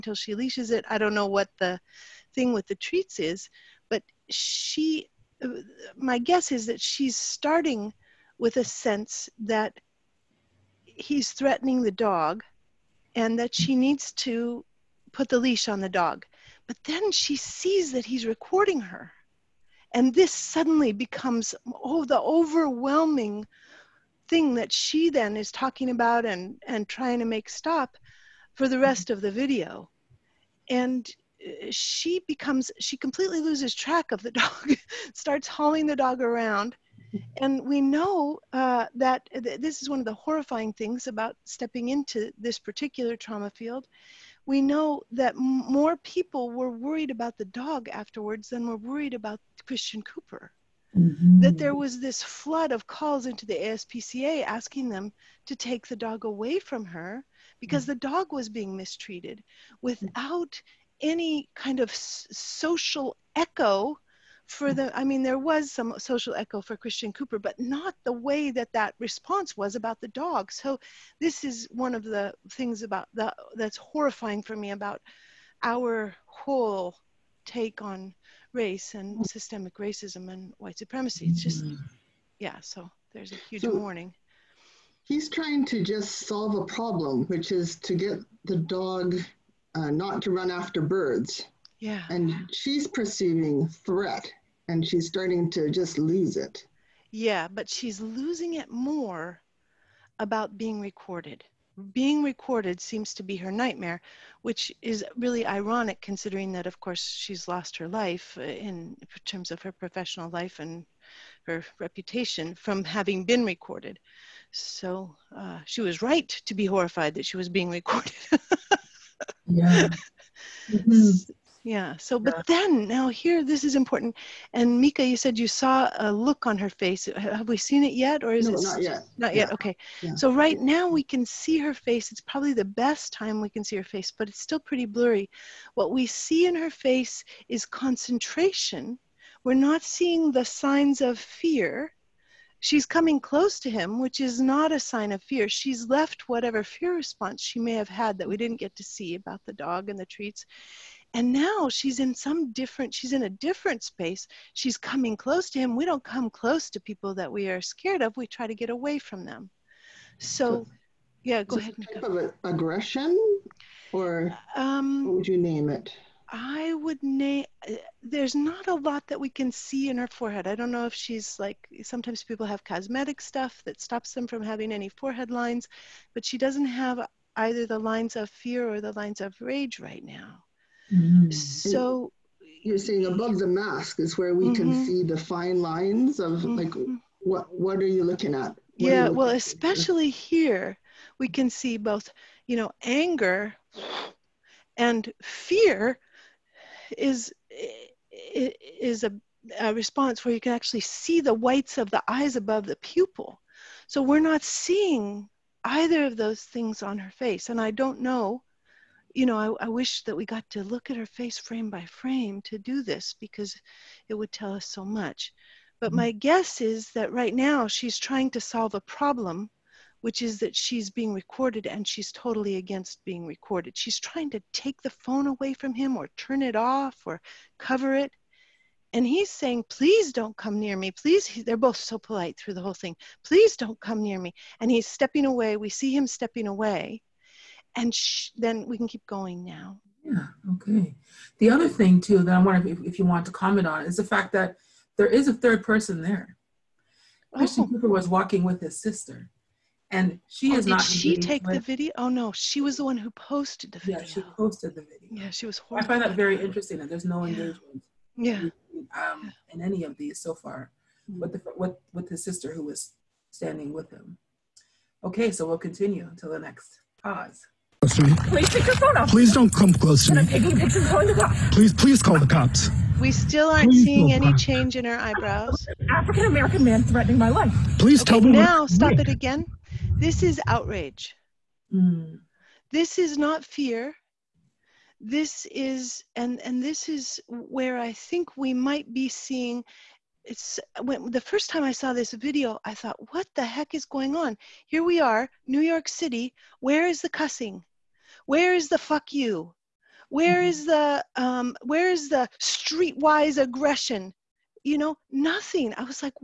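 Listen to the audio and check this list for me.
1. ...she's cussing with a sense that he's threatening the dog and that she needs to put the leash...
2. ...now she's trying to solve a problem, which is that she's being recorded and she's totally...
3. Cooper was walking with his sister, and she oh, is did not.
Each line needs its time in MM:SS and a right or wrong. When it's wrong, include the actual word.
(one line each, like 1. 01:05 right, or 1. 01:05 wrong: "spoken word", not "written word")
1. 00:06 wrong: "starting", not "cussing"
2. 03:37 right
3. 04:07 right.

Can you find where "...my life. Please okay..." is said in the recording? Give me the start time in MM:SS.
04:37.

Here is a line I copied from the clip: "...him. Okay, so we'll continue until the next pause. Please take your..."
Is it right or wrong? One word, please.
right.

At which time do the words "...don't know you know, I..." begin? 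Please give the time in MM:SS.
03:27.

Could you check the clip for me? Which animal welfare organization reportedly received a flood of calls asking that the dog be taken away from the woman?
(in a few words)
ASPCA.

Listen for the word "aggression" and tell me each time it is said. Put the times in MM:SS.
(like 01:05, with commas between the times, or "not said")
02:42, 05:03.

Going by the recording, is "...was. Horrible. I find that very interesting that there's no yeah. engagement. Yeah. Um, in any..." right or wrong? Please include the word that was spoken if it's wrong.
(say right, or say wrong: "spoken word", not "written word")
right.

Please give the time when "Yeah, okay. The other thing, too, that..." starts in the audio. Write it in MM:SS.
04:00.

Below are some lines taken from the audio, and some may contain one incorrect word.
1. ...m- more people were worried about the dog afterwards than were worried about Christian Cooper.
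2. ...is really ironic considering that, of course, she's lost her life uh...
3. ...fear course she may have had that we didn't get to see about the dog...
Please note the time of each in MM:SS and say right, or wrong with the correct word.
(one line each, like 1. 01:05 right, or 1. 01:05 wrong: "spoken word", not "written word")
1. 00:45 right
2. 01:44 right
3. 02:26 wrong: "response", not "course".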